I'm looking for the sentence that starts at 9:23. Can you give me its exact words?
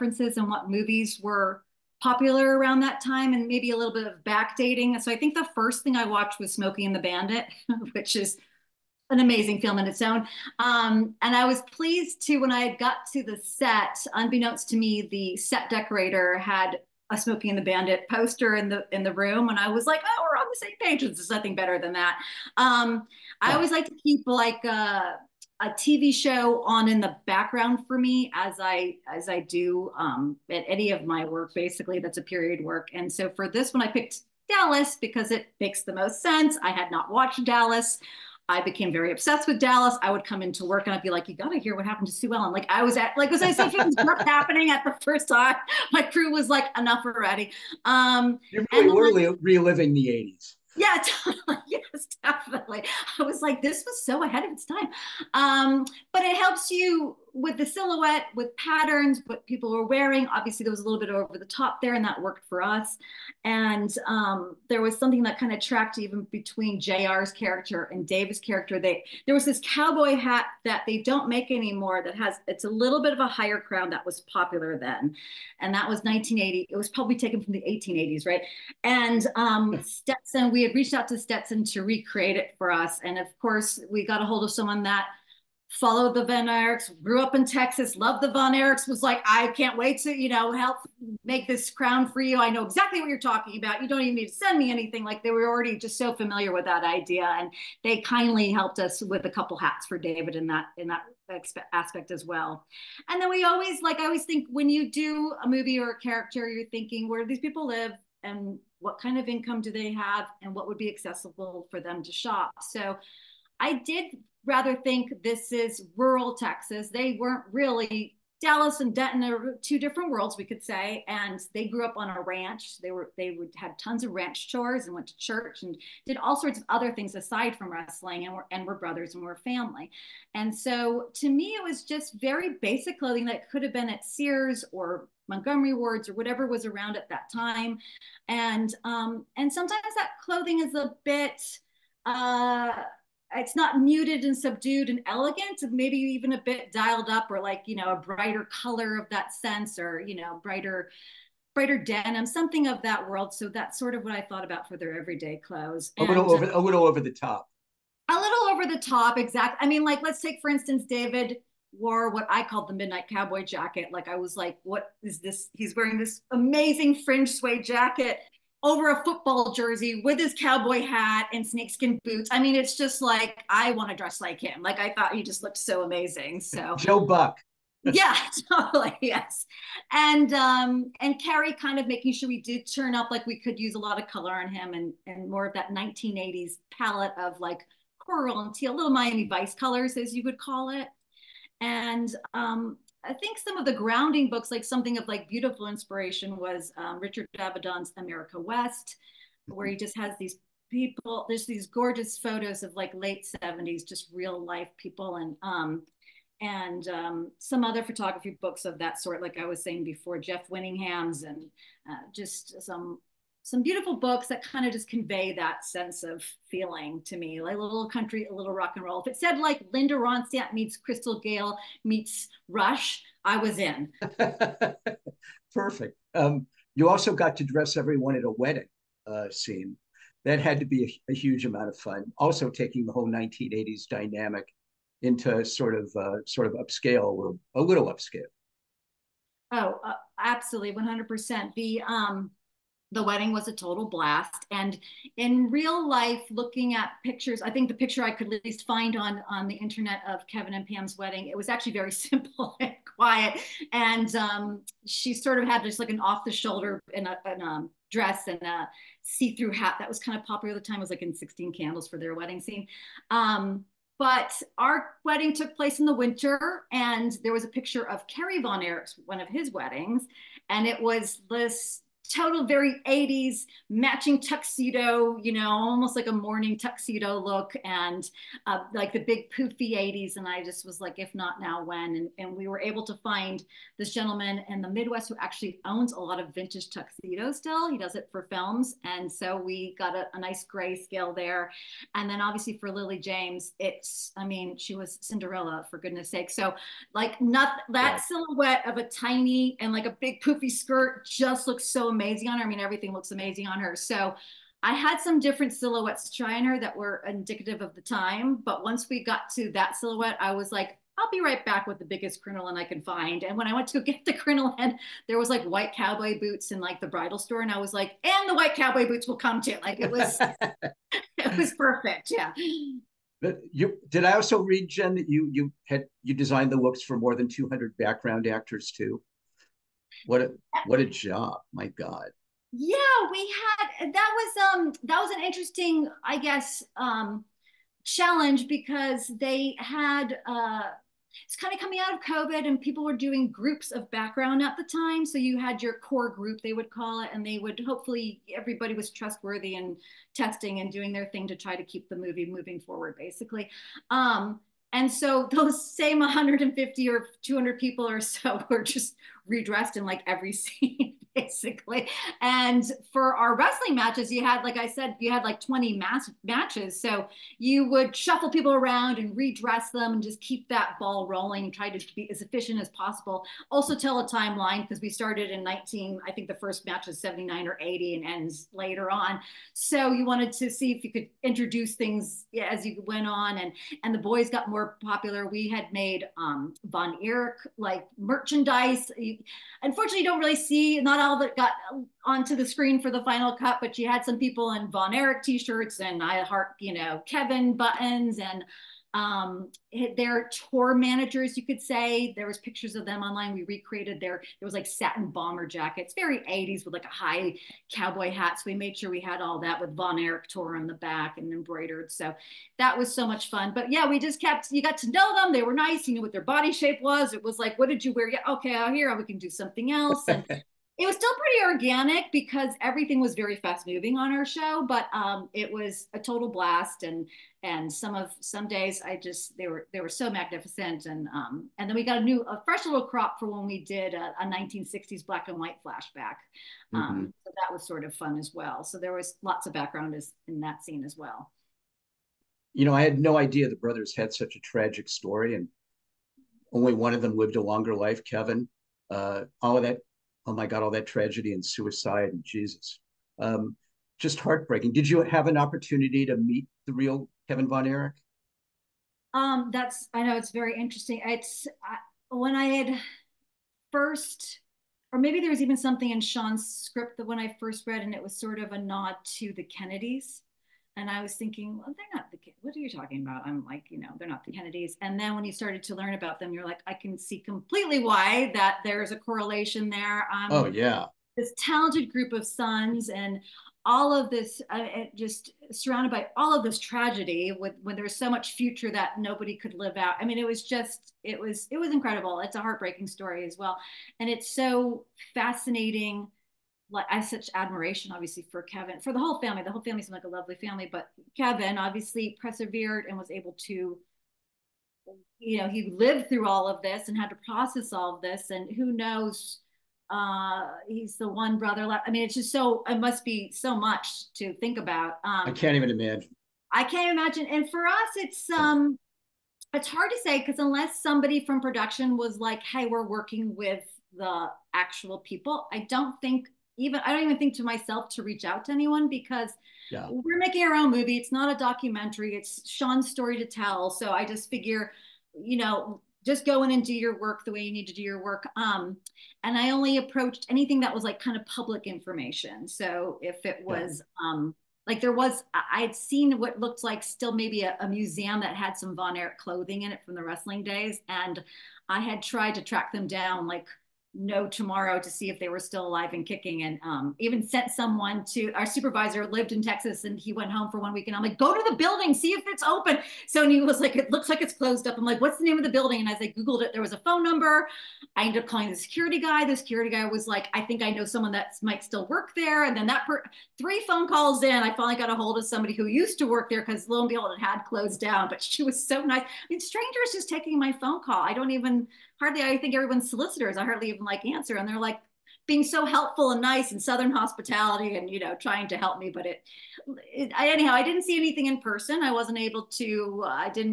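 So he was like, it looks like it's closed up.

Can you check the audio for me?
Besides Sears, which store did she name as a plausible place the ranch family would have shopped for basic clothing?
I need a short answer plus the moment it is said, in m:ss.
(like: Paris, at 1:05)
Montgomery Wards, at 2:15.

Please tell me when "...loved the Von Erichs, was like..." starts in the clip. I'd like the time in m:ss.
1:27.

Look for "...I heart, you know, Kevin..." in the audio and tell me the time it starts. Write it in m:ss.
6:36.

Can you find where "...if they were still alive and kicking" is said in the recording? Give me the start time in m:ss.
9:15.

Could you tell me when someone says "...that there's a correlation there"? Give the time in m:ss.
7:58.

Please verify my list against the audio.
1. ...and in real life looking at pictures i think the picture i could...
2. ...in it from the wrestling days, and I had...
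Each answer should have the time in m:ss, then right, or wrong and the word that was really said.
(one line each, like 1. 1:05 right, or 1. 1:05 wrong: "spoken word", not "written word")
1. 4:04 right
2. 9:09 right.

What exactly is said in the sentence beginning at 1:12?
That has it's a little bit of a higher crown that was popular then, and that was 1980.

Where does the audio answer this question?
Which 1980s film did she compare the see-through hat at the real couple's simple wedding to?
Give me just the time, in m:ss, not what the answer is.
4:21.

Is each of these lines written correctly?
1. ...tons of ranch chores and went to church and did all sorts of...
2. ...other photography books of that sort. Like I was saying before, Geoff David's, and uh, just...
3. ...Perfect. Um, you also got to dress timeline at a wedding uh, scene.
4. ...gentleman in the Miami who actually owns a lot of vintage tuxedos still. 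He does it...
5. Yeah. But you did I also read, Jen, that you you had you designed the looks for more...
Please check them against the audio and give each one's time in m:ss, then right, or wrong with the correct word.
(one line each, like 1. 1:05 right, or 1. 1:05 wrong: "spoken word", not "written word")
1. 2:03 right
2. 3:27 wrong: "Winningham", not "David"
3. 3:45 wrong: "everyone", not "timeline"
4. 4:43 wrong: "Midwest", not "Miami"
5. 5:22 right.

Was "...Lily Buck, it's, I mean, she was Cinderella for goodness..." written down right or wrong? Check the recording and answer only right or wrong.
wrong.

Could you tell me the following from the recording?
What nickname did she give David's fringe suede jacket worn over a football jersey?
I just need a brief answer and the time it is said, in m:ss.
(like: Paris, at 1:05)
the midnight cowboy jacket, at 2:42.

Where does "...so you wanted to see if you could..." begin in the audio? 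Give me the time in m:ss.
6:19.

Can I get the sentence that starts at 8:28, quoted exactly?
And who knows, uh, he's the one brother left.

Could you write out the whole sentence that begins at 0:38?
I became very obsessed with Dallas.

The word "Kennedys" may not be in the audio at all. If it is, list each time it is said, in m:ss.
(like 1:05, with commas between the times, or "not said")
7:49, 7:54.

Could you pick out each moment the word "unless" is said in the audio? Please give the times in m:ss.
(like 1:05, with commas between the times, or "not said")
8:40.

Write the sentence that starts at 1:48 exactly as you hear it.
And what kind of income do they have?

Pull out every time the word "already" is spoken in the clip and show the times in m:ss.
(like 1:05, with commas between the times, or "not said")
0:47, 1:35.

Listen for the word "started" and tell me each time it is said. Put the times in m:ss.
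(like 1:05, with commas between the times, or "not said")
6:14, 7:55.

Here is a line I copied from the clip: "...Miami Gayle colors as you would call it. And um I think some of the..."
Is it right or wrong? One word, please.
wrong.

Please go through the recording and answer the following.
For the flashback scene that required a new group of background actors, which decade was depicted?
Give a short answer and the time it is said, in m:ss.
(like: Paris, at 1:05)
1960s, at 7:14.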